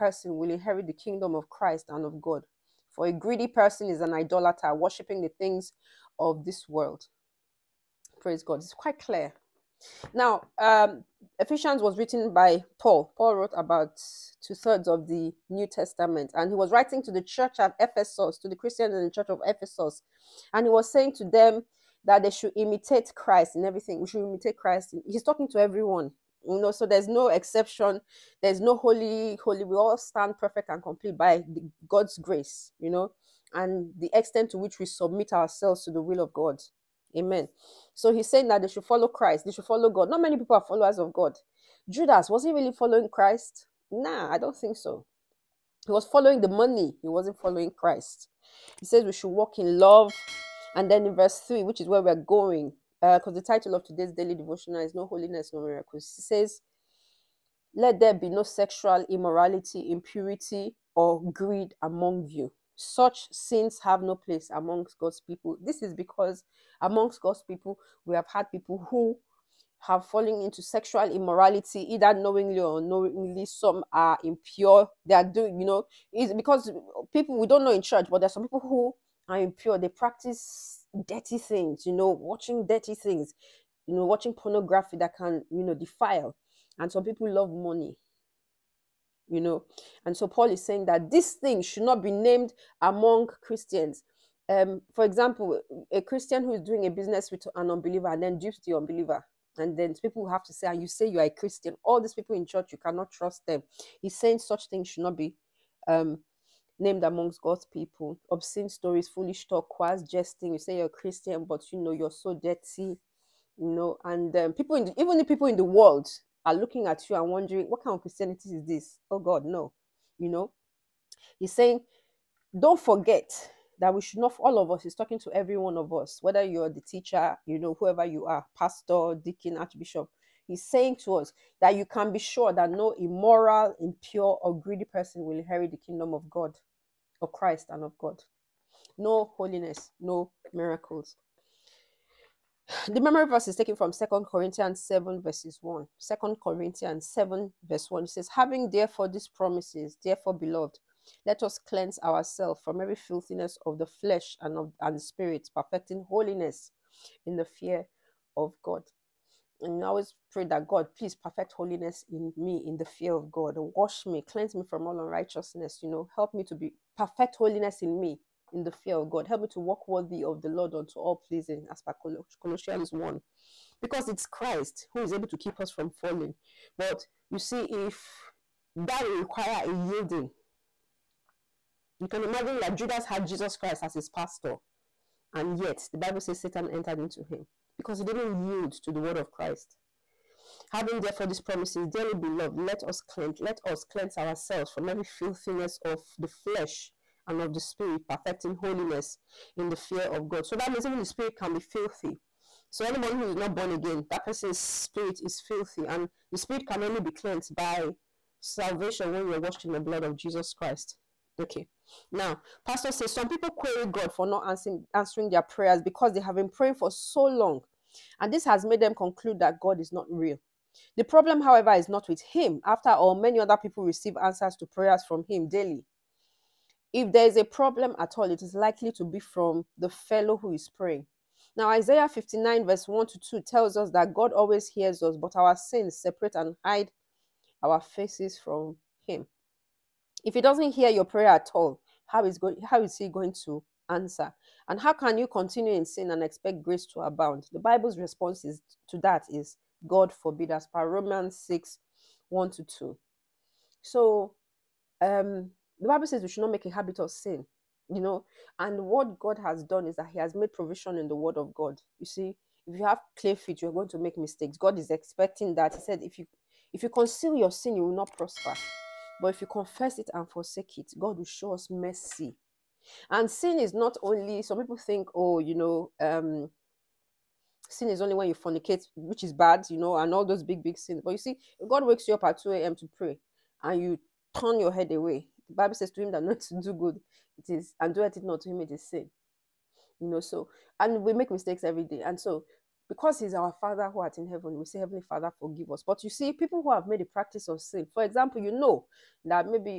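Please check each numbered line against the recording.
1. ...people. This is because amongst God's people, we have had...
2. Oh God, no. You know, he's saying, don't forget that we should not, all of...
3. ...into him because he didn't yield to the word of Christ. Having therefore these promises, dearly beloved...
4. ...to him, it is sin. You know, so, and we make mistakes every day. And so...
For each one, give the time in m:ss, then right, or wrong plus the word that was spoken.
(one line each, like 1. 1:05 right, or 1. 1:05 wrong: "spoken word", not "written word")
1. 1:05 right
2. 1:59 right
3. 3:06 right
4. 4:48 right.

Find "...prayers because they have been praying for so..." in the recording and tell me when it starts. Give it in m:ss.
3:35.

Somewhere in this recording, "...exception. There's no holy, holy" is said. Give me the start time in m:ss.
0:27.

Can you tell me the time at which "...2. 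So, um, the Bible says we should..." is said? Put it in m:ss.
4:12.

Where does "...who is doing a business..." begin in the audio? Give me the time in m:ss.
1:36.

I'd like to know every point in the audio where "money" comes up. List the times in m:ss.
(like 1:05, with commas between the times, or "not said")
0:46, 1:27.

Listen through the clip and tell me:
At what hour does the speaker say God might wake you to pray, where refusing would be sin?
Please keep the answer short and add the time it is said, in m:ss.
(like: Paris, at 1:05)
2 a.m., at 4:42.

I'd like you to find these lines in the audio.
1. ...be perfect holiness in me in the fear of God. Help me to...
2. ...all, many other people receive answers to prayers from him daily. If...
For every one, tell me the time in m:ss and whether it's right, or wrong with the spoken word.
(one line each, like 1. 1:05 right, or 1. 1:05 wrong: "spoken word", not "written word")
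1. 2:46 right
2. 3:42 right.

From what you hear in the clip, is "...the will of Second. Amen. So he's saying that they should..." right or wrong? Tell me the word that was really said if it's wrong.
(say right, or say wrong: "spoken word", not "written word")
wrong: "God", not "Second".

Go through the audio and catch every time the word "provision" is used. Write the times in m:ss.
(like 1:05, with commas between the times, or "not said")
4:20.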